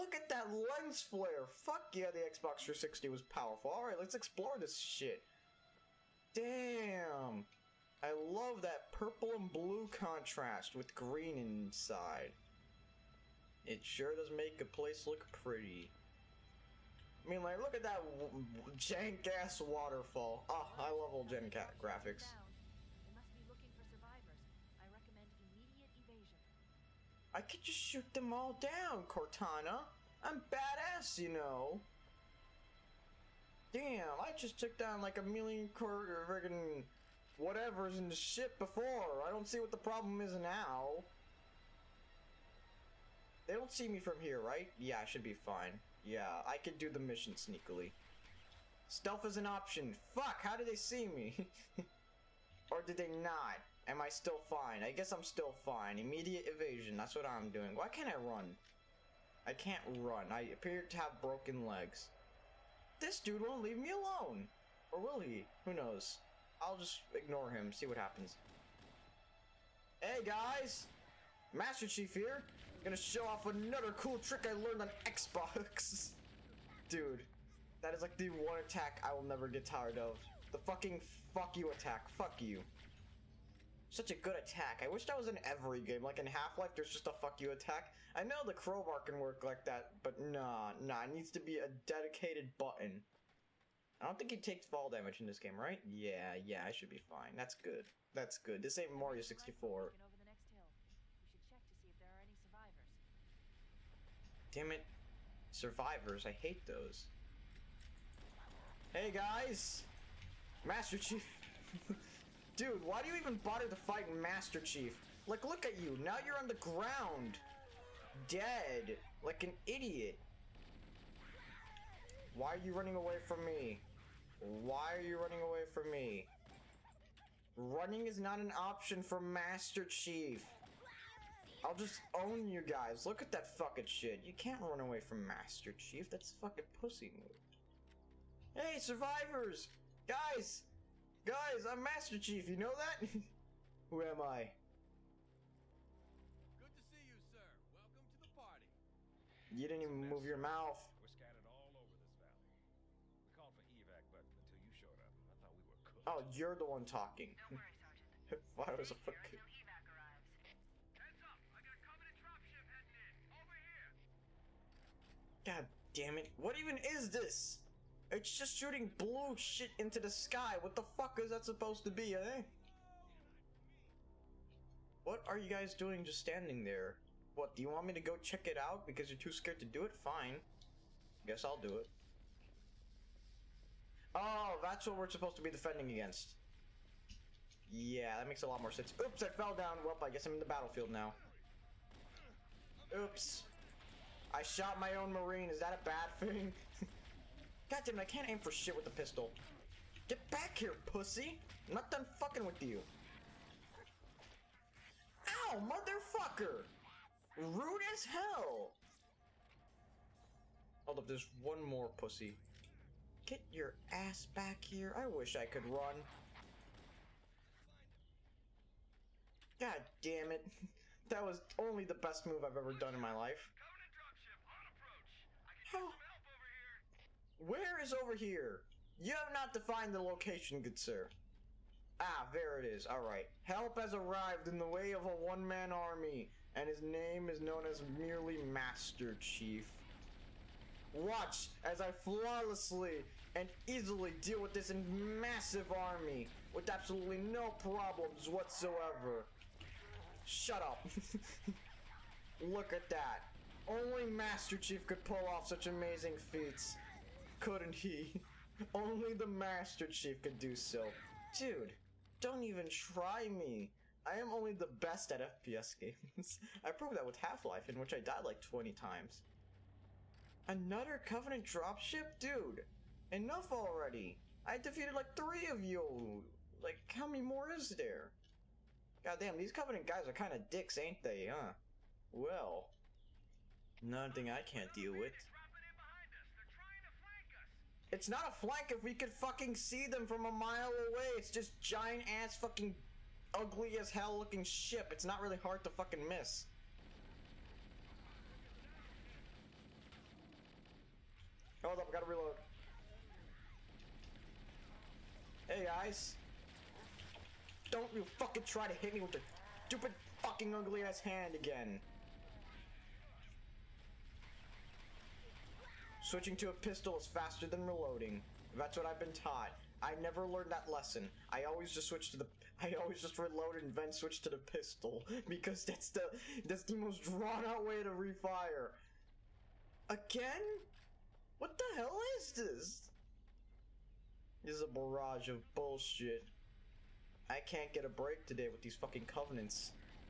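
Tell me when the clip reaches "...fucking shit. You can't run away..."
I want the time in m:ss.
2:13.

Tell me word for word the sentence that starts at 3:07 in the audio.
Yeah, that makes a lot more sense.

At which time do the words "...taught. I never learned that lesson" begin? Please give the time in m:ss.
5:19.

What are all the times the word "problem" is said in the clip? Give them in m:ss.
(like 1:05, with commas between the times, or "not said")
0:39, 4:07.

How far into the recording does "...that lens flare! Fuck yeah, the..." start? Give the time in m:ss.
0:00.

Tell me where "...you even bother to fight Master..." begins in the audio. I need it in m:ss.
1:53.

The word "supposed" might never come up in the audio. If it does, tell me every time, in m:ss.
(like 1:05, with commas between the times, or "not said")
2:51, 3:05.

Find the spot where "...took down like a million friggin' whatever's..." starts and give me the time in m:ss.
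0:34.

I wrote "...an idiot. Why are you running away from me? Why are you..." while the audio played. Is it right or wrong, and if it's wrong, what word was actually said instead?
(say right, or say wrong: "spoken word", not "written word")
right.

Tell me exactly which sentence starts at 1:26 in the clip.
Like in Half-Life, there's just a fuck you attack.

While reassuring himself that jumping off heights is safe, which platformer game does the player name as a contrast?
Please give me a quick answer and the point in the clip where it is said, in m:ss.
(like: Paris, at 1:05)
Mario 64, at 1:38.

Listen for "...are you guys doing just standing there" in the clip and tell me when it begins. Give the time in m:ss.
2:55.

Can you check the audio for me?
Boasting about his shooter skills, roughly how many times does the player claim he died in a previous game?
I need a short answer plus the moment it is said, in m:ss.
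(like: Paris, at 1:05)
20, at 4:28.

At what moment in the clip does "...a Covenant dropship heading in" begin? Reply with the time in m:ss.
2:41.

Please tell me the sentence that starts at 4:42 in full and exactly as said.
Well, nothing I can't deal with.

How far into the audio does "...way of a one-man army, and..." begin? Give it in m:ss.
3:54.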